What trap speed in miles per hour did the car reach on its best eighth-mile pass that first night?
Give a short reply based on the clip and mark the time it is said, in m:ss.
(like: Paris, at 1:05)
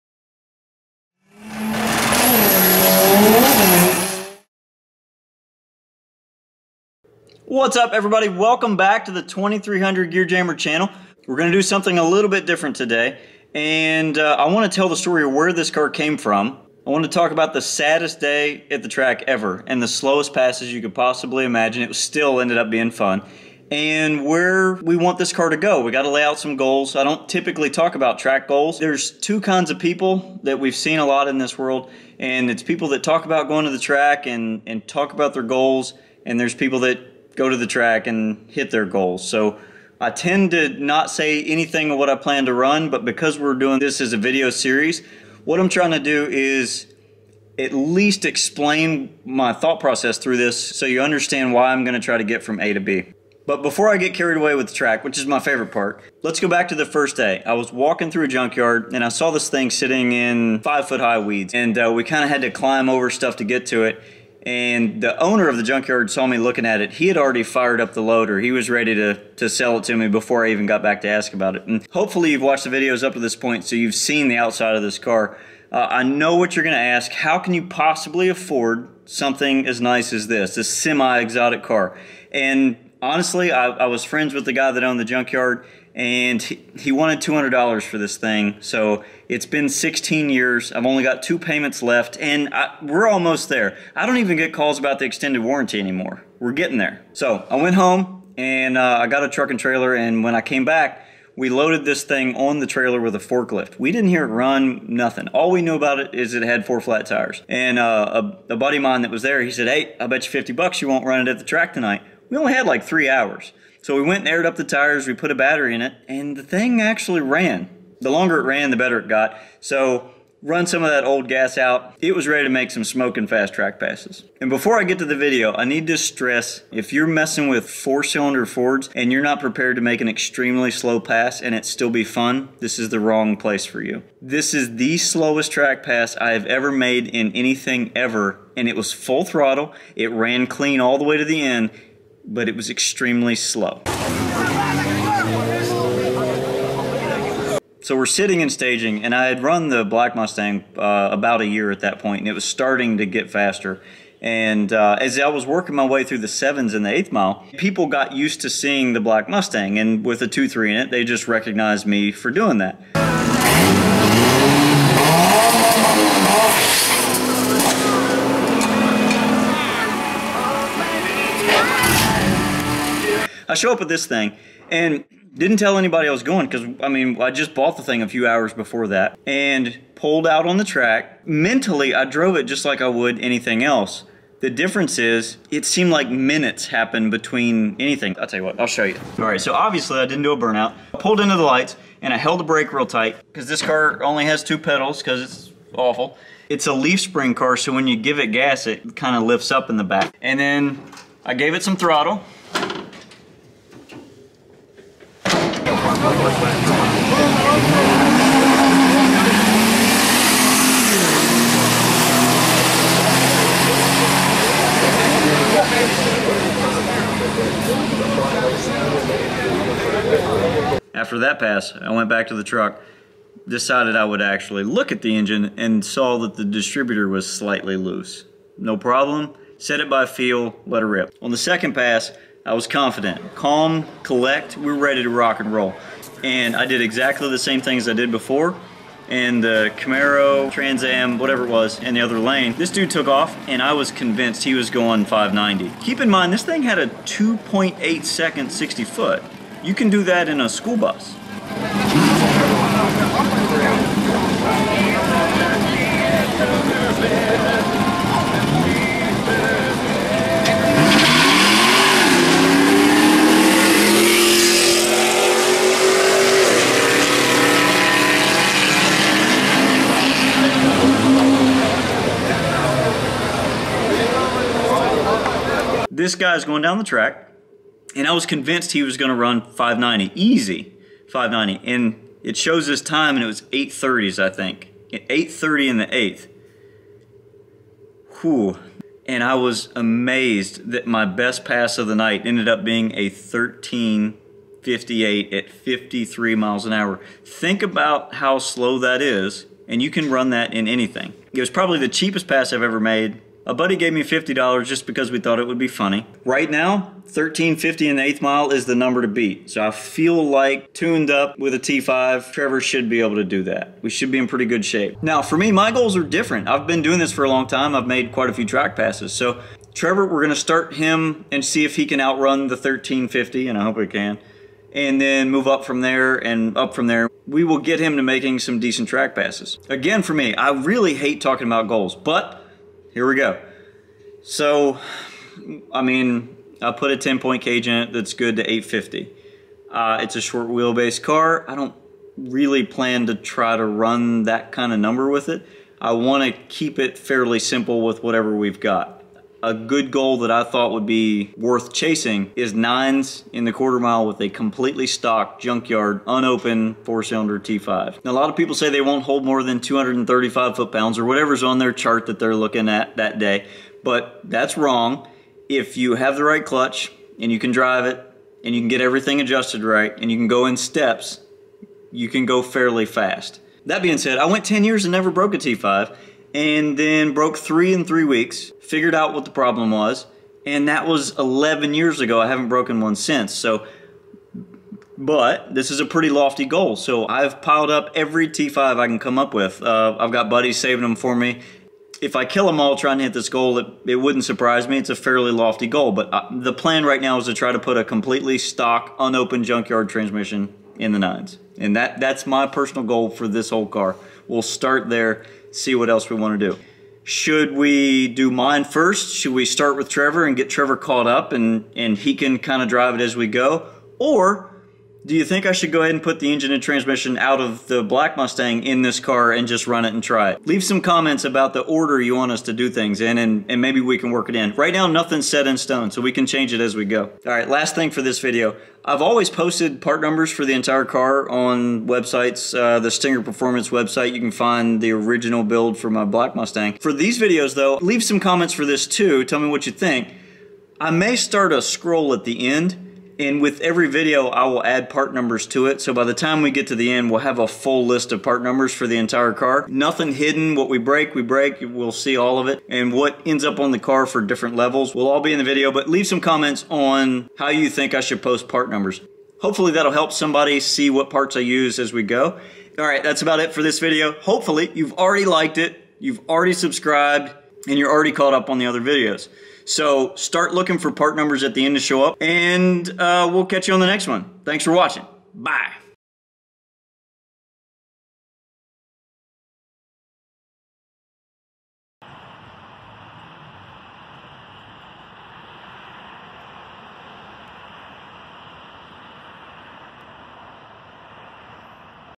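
53, at 4:55.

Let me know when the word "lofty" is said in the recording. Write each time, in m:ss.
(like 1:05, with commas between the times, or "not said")
6:26, 6:35.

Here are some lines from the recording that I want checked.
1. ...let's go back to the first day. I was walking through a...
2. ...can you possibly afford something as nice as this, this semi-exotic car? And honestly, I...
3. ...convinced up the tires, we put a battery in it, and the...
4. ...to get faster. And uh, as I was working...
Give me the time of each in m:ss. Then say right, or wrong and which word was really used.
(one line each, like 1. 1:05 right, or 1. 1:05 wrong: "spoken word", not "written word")
1. 0:56 right
2. 1:17 right
3. 1:54 wrong: "aired", not "convinced"
4. 2:32 right.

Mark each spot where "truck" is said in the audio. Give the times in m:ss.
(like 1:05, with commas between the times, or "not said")
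1:39, 3:42.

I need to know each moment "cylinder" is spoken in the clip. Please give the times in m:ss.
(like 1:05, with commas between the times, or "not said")
2:08, 5:57.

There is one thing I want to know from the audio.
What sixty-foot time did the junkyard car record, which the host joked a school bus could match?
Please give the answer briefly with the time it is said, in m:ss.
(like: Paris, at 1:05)
2.8 seconds, at 4:06.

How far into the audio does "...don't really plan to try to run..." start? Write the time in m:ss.
5:41.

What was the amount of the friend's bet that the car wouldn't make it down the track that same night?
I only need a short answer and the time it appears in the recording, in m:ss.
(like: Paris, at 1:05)
50 bucks, at 1:50.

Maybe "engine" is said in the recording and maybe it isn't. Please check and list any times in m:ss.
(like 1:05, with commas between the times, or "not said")
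3:45, 6:56.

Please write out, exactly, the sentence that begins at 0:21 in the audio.
It still ended up being fun and where we want this car to go.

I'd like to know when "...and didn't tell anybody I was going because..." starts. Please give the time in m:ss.
2:54.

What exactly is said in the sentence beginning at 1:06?
He had already fired up the loader.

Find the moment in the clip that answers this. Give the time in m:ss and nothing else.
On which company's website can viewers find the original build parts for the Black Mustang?
7:12.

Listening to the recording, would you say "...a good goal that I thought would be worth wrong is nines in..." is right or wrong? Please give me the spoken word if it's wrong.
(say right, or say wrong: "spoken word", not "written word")
wrong: "chasing", not "wrong".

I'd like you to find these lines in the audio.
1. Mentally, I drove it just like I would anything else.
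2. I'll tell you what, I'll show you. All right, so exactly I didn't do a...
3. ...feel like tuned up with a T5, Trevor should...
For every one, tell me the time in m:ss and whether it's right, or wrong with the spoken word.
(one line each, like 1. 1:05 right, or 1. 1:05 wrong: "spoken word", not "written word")
1. 3:01 right
2. 3:08 wrong: "obviously", not "exactly"
3. 5:09 right.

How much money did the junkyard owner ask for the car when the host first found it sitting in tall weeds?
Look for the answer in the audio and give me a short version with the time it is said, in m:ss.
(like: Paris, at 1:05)
$200, at 1:27.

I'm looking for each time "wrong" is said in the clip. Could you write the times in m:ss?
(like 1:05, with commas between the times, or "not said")
2:12, 6:04.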